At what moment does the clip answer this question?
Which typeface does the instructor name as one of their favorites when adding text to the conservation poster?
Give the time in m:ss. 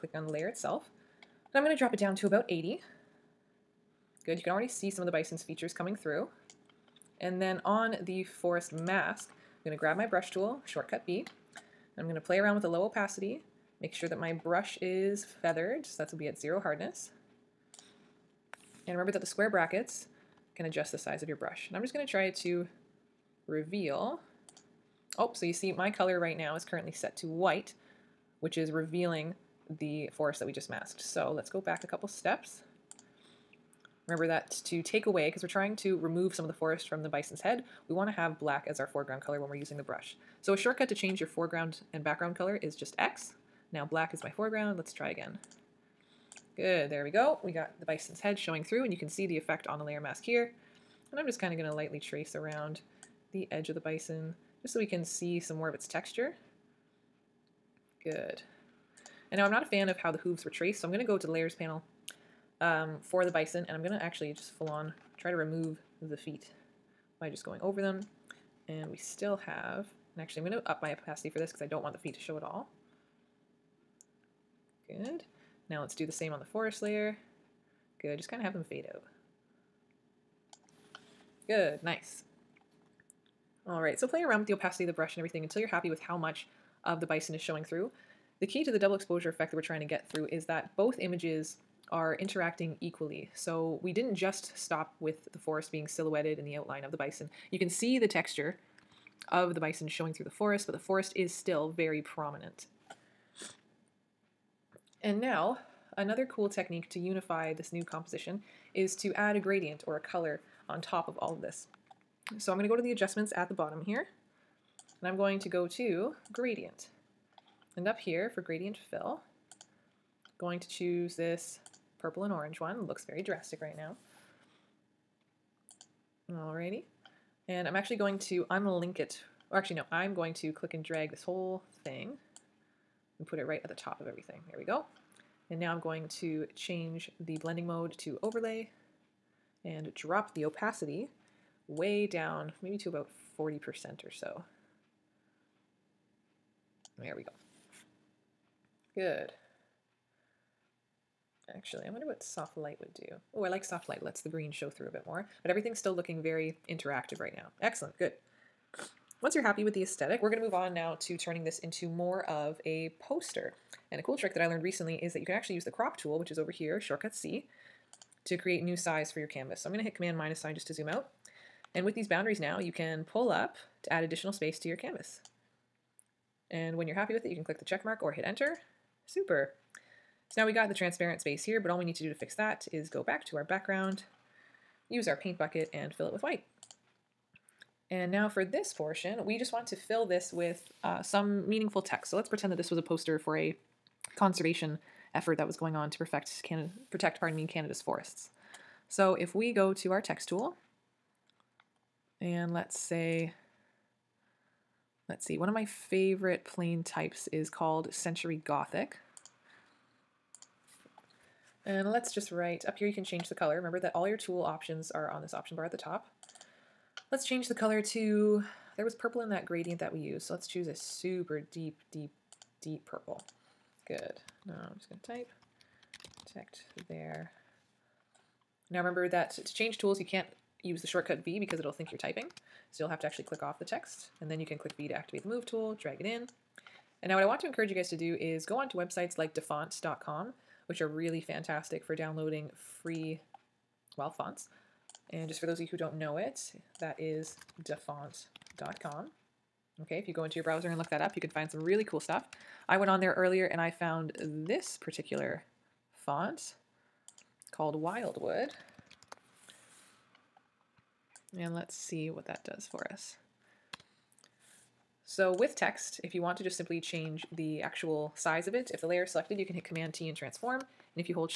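3:27.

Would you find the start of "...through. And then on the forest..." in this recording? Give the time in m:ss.
0:05.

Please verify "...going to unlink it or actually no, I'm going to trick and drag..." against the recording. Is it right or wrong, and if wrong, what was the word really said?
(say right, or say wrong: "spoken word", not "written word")
wrong: "click", not "trick".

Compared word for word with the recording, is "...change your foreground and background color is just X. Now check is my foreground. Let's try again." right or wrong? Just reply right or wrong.
wrong.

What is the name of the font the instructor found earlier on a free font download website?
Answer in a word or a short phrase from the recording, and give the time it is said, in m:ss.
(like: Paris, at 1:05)
Wildwood, at 4:17.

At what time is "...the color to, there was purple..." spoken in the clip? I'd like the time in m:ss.
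3:37.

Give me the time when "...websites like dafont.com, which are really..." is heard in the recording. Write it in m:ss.
3:58.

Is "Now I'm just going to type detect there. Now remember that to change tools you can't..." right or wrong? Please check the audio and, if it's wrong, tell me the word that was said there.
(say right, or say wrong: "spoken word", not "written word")
right.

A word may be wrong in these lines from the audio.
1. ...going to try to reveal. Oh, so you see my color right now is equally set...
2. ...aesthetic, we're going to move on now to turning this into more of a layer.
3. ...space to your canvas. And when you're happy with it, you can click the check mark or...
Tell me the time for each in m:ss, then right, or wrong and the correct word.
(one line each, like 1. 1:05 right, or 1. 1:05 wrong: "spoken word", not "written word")
1. 0:21 wrong: "currently", not "equally"
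2. 2:39 wrong: "poster", not "layer"
3. 2:54 right.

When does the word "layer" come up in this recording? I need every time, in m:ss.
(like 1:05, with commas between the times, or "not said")
0:00, 0:49, 1:01, 1:16, 4:28.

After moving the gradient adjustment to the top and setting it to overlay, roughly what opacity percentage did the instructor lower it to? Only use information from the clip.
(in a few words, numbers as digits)
40%.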